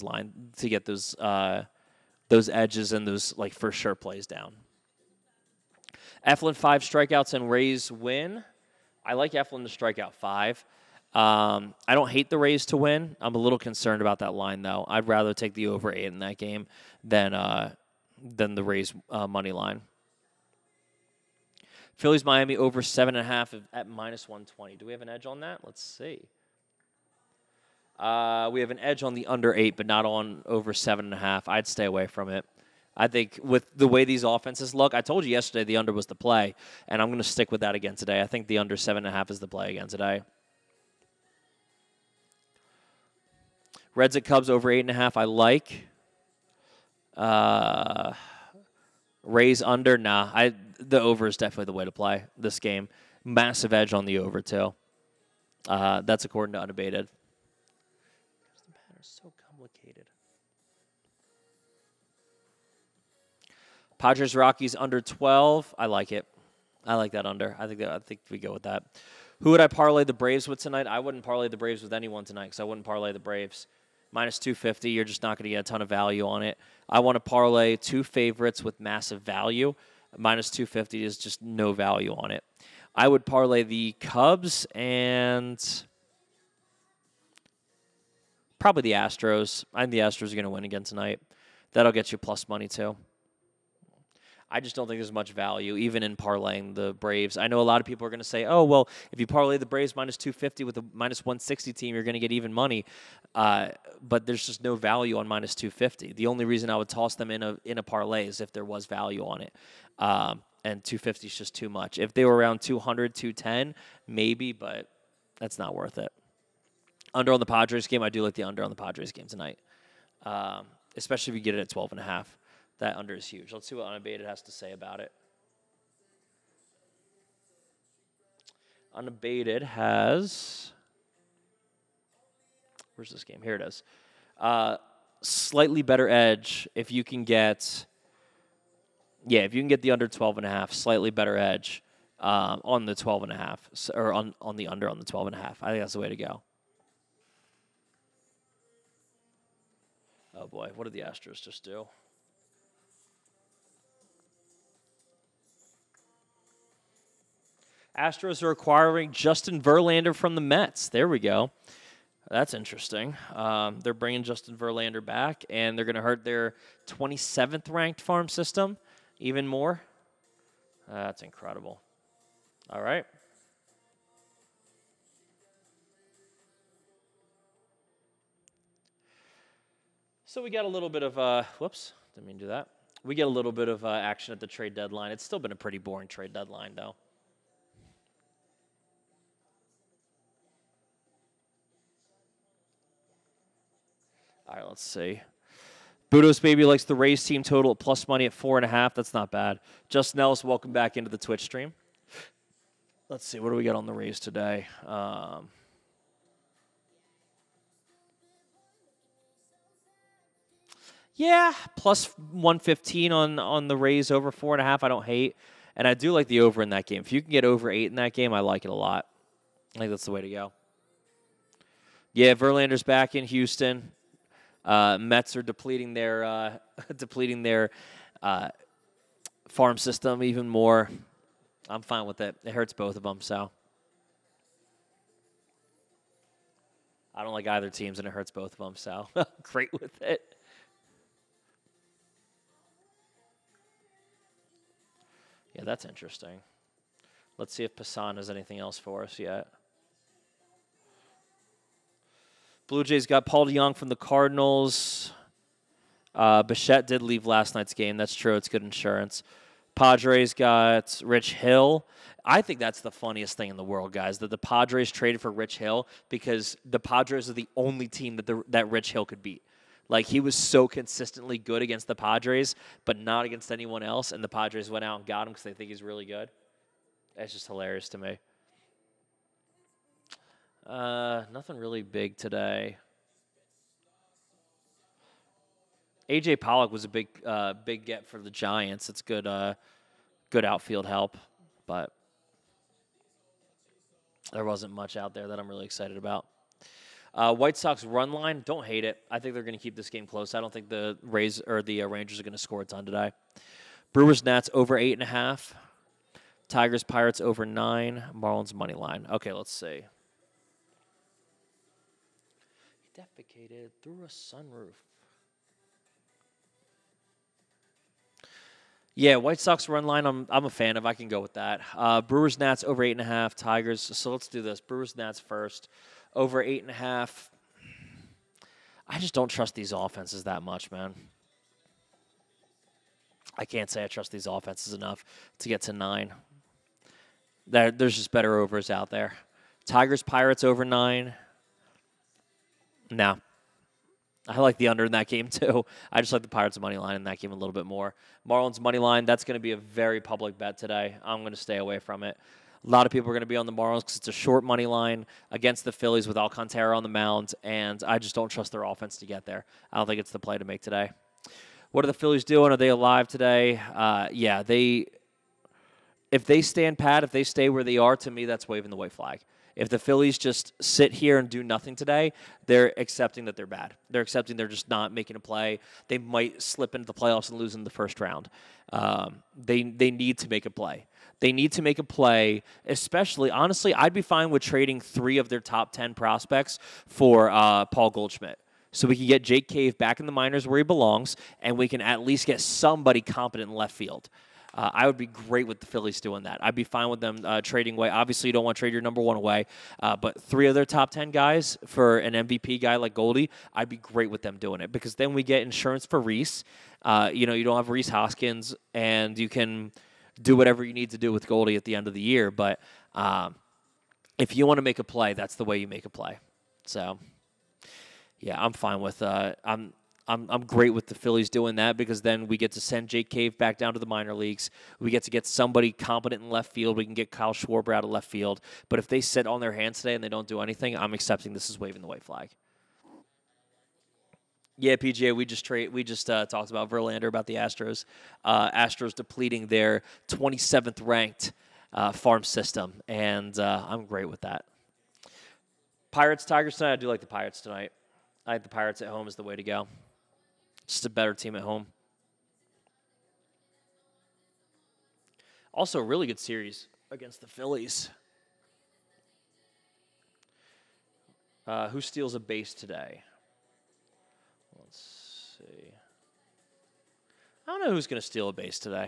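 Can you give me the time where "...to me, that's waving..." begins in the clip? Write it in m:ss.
6:07.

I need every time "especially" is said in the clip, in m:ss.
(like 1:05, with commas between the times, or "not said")
2:00, 6:22.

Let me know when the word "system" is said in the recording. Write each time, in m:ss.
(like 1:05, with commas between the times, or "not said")
2:48, 3:49, 7:22.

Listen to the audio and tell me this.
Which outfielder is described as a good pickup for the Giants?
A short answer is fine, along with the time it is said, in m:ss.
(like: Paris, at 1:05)
AJ Pollock, at 4:46.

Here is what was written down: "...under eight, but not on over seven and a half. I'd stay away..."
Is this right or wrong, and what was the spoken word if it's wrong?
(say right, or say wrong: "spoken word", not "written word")
right.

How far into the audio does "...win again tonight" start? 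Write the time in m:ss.
1:30.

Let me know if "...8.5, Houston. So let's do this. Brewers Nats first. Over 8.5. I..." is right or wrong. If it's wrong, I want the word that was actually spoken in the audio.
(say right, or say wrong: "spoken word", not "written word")
wrong: "Tigers", not "Houston".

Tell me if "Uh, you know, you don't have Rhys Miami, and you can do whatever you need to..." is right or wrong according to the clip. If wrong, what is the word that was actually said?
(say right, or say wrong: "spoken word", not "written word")
wrong: "Hoskins", not "Miami".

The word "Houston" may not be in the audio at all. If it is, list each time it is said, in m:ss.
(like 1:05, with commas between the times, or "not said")
3:43.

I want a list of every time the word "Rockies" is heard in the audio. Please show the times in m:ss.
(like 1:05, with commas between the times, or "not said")
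1:04.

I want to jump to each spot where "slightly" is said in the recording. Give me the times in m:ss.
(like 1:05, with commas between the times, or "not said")
2:15, 2:20.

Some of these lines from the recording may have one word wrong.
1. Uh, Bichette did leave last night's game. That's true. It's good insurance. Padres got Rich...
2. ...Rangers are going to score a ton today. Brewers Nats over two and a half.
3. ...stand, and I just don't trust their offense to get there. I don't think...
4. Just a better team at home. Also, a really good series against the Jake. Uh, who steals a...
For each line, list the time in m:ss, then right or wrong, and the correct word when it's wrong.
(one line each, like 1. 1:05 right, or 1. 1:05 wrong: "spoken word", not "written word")
1. 4:16 right
2. 5:01 wrong: "eight", not "two"
3. 5:56 wrong: "mound", not "stand"
4. 7:30 wrong: "Phillies", not "Jake".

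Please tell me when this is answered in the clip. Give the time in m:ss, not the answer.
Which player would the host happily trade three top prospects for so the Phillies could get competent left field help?
6:27.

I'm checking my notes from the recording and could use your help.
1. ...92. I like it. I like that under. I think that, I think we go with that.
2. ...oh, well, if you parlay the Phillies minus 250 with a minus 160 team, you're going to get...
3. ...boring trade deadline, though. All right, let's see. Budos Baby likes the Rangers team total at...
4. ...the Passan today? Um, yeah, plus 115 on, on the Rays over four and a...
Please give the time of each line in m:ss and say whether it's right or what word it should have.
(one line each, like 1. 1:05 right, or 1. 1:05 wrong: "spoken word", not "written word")
1. 1:05 wrong: "12", not "92"
2. 1:38 wrong: "Braves", not "Phillies"
3. 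3:05 wrong: "Rays", not "Rangers"
4. 3:23 wrong: "Rays", not "Passan".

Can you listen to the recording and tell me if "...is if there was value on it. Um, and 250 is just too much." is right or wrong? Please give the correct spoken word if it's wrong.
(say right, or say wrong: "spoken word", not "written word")
right.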